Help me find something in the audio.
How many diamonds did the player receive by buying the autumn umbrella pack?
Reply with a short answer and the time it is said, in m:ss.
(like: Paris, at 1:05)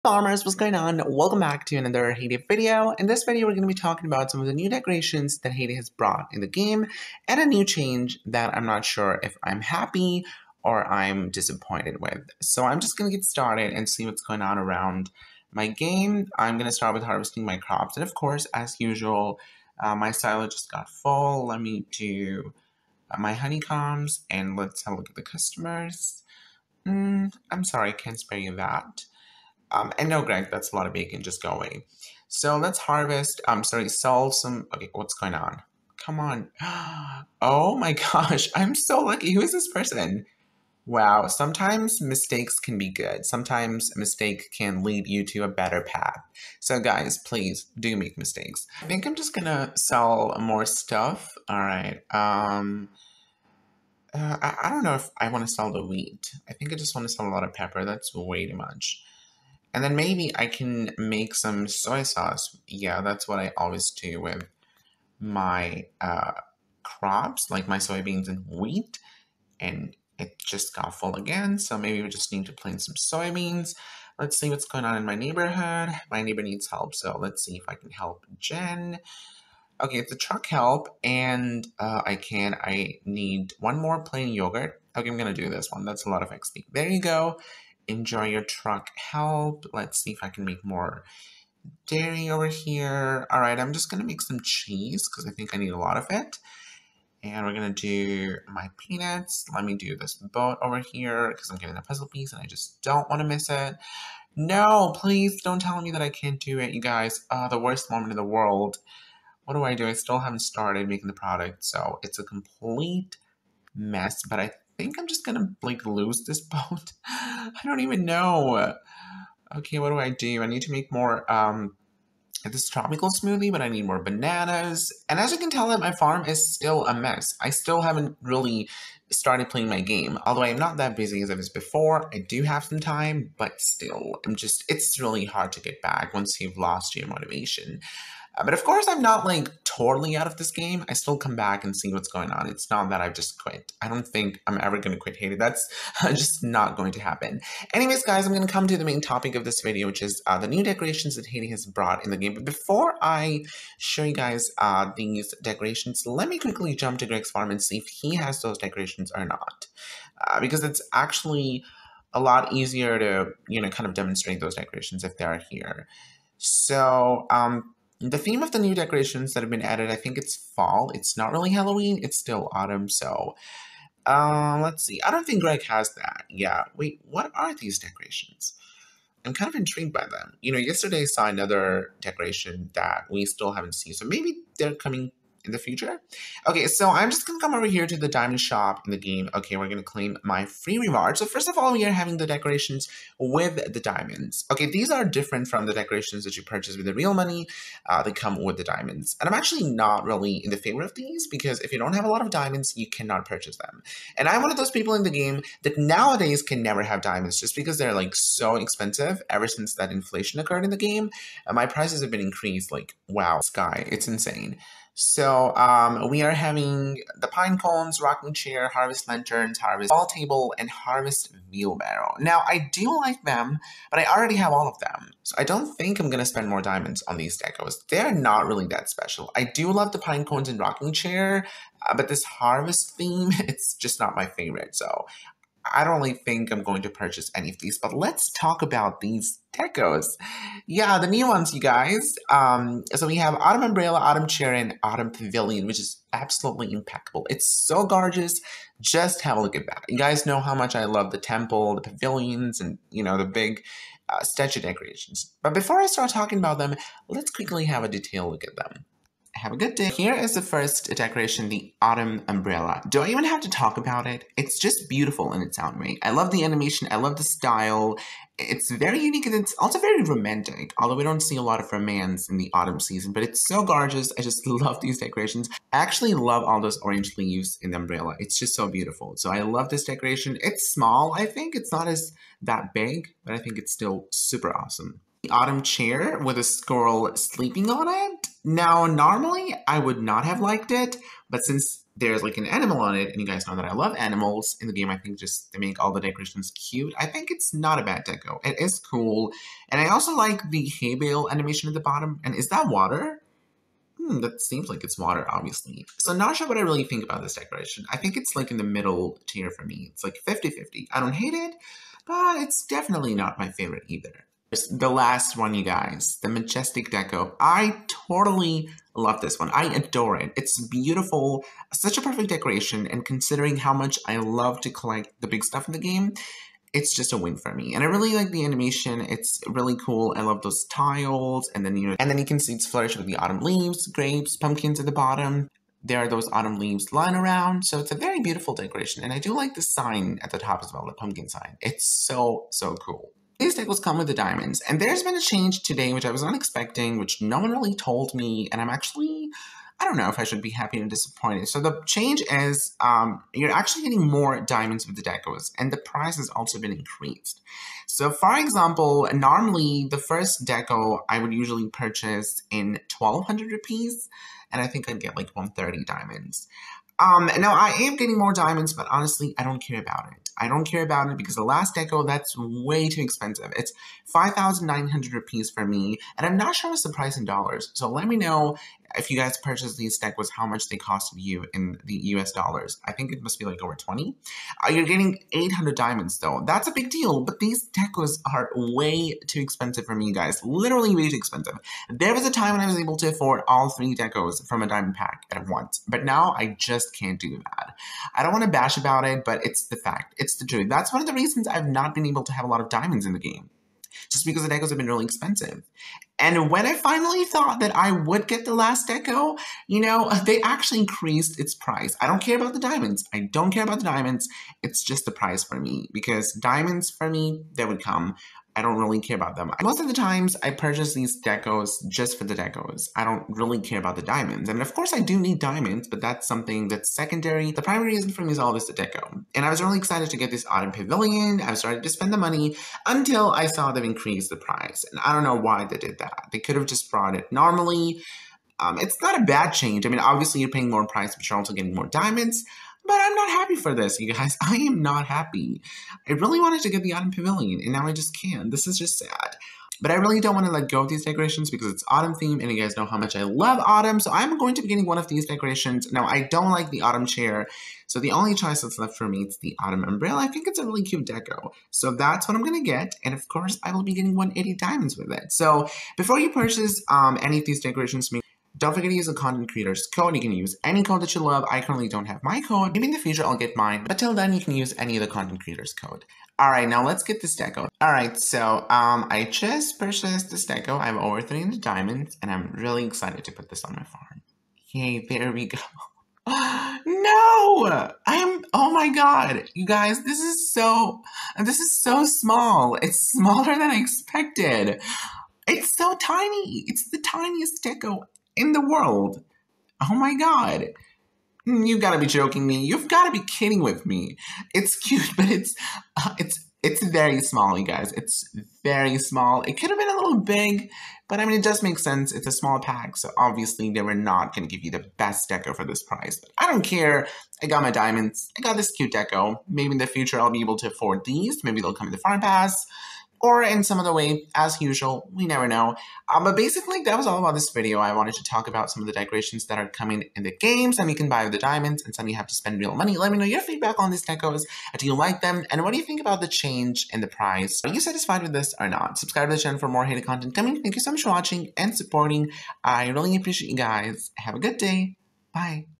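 180, at 7:44.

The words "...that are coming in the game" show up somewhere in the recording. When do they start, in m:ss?
8:49.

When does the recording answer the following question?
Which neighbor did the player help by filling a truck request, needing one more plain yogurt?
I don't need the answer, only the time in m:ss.
1:18.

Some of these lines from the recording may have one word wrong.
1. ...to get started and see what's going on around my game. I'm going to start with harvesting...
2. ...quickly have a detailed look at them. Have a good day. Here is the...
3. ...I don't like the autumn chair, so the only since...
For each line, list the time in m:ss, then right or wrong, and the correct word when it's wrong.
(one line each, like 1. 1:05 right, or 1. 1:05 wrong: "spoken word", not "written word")
1. 0:13 right
2. 4:17 right
3. 7:36 wrong: "choice", not "since".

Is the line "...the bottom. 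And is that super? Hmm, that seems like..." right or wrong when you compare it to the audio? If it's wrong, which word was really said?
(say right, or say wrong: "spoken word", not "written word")
wrong: "water", not "super".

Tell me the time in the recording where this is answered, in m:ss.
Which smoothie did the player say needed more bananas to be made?
2:02.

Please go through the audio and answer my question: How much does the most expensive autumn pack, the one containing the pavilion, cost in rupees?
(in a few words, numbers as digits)
5,900 rupees.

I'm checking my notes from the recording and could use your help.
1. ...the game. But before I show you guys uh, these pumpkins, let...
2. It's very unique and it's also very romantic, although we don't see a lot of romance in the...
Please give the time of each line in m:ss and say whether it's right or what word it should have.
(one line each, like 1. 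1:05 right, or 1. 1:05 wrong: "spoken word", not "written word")
1. 2:32 wrong: "decorations", not "pumpkins"
2. 4:28 right.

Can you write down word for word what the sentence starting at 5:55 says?
And the price has also been increased.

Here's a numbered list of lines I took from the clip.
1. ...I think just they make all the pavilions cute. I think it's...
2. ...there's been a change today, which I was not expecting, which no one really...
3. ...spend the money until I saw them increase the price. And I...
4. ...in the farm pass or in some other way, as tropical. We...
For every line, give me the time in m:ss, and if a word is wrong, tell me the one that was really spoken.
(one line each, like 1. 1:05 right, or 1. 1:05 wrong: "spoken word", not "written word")
1. 4:54 wrong: "decorations", not "pavilions"
2. 5:44 right
3. 7:11 right
4. 8:41 wrong: "usual", not "tropical".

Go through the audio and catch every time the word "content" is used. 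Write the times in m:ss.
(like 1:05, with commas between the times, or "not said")
7:49, 7:55, 9:00.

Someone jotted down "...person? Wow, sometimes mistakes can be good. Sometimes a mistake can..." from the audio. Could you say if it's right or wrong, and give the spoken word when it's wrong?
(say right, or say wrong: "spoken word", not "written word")
right.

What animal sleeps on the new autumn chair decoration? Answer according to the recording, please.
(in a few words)
squirrel.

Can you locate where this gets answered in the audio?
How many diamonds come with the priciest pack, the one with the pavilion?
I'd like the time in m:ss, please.
6:25.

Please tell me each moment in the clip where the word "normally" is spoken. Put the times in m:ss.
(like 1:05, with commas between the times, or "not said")
4:48, 5:59, 7:17.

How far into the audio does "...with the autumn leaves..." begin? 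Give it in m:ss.
5:32.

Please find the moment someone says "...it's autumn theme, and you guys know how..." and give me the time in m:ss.
7:31.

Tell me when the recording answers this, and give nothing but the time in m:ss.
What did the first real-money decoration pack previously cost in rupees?
6:02.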